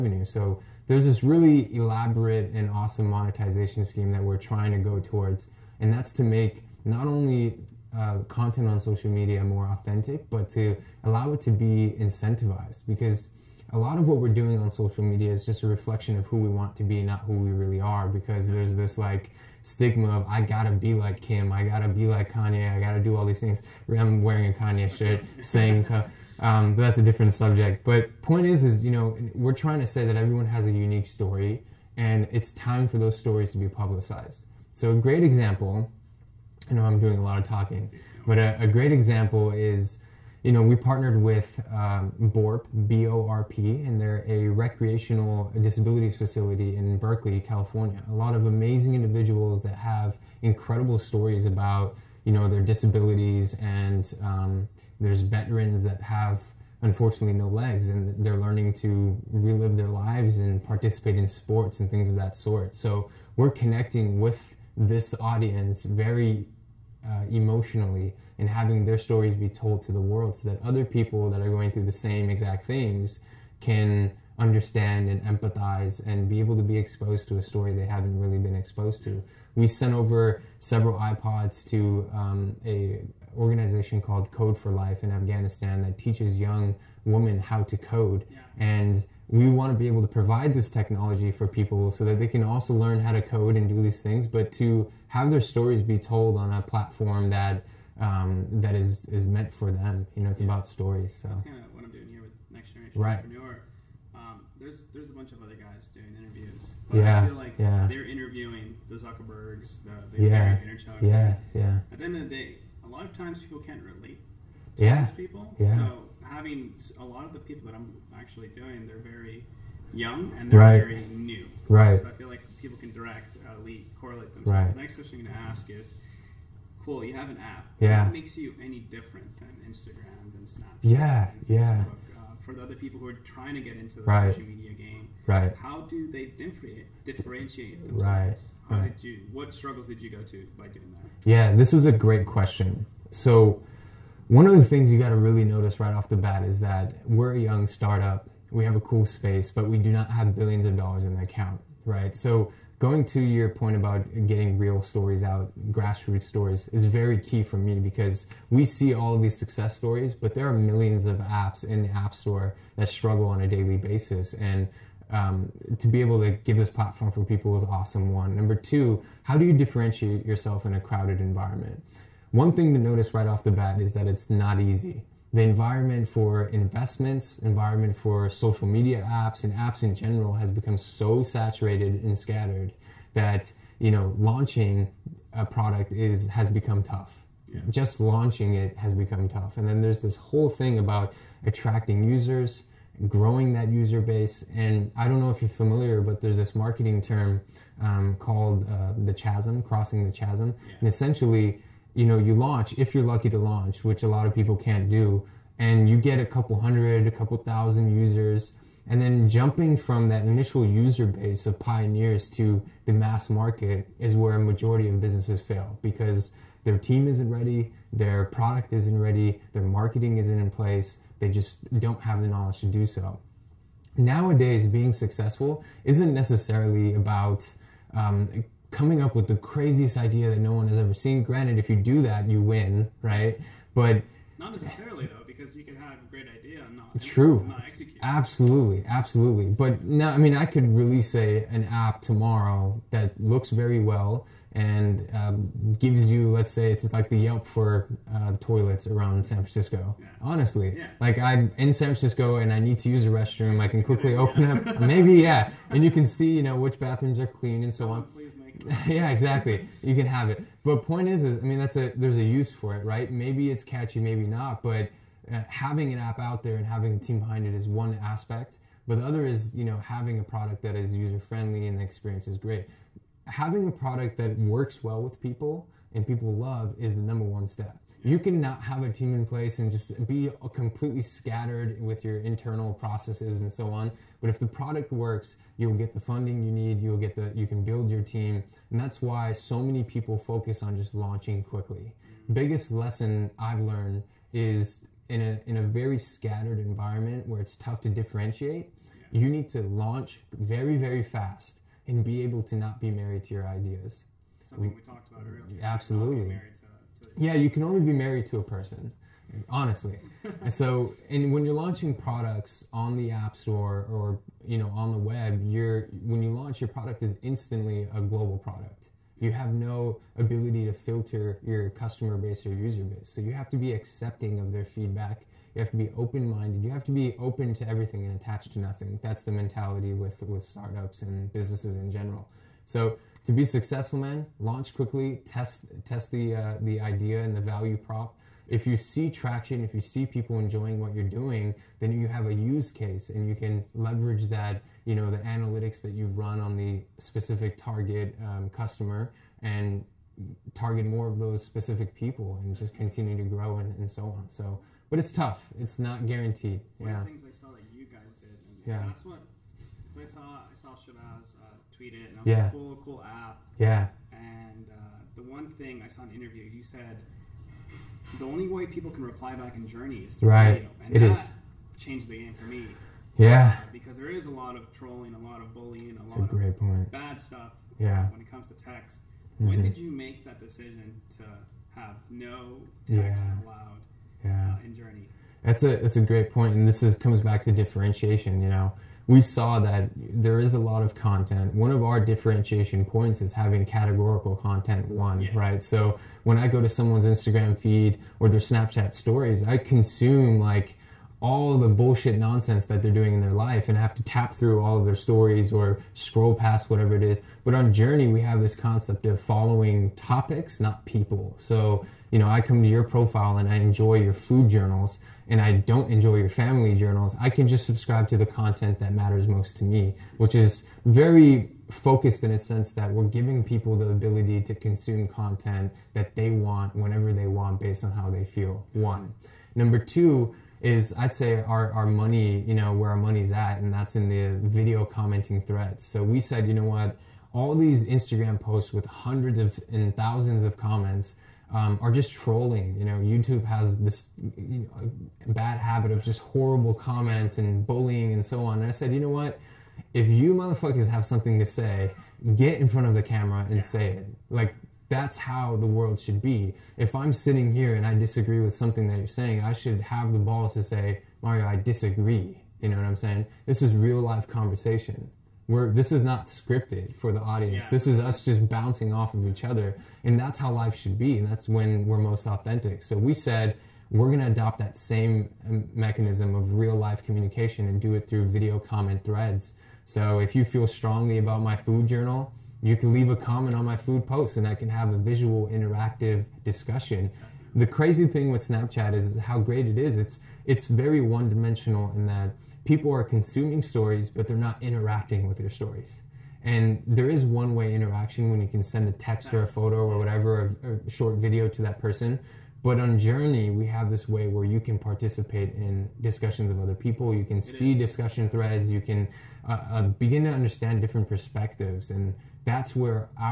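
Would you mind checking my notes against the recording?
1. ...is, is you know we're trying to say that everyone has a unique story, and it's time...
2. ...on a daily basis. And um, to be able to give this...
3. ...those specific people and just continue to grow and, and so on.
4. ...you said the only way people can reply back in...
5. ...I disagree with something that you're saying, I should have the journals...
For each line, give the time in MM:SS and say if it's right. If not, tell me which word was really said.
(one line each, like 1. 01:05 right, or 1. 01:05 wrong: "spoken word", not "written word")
1. 00:28 right
2. 02:43 right
3. 05:51 right
4. 06:06 right
5. 07:37 wrong: "balls", not "journals".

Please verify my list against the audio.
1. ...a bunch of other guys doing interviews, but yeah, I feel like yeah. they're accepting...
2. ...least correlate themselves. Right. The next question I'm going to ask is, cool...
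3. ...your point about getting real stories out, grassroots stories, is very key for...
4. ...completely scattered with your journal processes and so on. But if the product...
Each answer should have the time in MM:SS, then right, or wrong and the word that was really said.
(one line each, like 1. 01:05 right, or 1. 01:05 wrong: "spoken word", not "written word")
1. 01:45 wrong: "interviewing", not "accepting"
2. 02:03 right
3. 02:33 right
4. 04:40 wrong: "internal", not "journal".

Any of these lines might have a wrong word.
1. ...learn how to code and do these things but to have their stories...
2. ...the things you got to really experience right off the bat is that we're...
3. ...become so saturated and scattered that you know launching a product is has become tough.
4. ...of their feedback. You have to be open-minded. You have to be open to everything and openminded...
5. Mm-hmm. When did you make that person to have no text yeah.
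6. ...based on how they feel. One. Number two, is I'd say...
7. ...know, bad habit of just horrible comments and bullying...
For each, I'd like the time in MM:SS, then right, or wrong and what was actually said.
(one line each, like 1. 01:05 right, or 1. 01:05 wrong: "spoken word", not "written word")
1. 01:32 right
2. 02:24 wrong: "notice", not "experience"
3. 03:00 right
4. 05:24 wrong: "attached", not "openminded"
5. 06:19 wrong: "decision", not "person"
6. 07:07 right
7. 07:24 right.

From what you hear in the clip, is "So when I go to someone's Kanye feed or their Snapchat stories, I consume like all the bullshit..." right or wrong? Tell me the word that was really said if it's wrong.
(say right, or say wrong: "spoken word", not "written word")
wrong: "Instagram", not "Kanye".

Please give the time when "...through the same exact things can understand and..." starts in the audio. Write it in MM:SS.
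01:11.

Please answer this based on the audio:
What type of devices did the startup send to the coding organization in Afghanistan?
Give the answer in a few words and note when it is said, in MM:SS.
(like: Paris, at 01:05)
iPods, at 01:20.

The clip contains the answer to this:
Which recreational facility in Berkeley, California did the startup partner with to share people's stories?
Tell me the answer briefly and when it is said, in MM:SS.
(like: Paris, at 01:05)
BORP, at 00:42.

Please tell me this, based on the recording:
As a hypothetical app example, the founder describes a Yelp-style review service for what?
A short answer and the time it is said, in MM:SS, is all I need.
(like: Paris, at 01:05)
toilets, at 04:08.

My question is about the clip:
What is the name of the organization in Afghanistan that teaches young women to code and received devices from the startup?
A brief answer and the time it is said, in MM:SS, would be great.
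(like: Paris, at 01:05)
Code for Life, at 01:24.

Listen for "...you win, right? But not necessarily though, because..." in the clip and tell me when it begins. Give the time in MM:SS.
03:52.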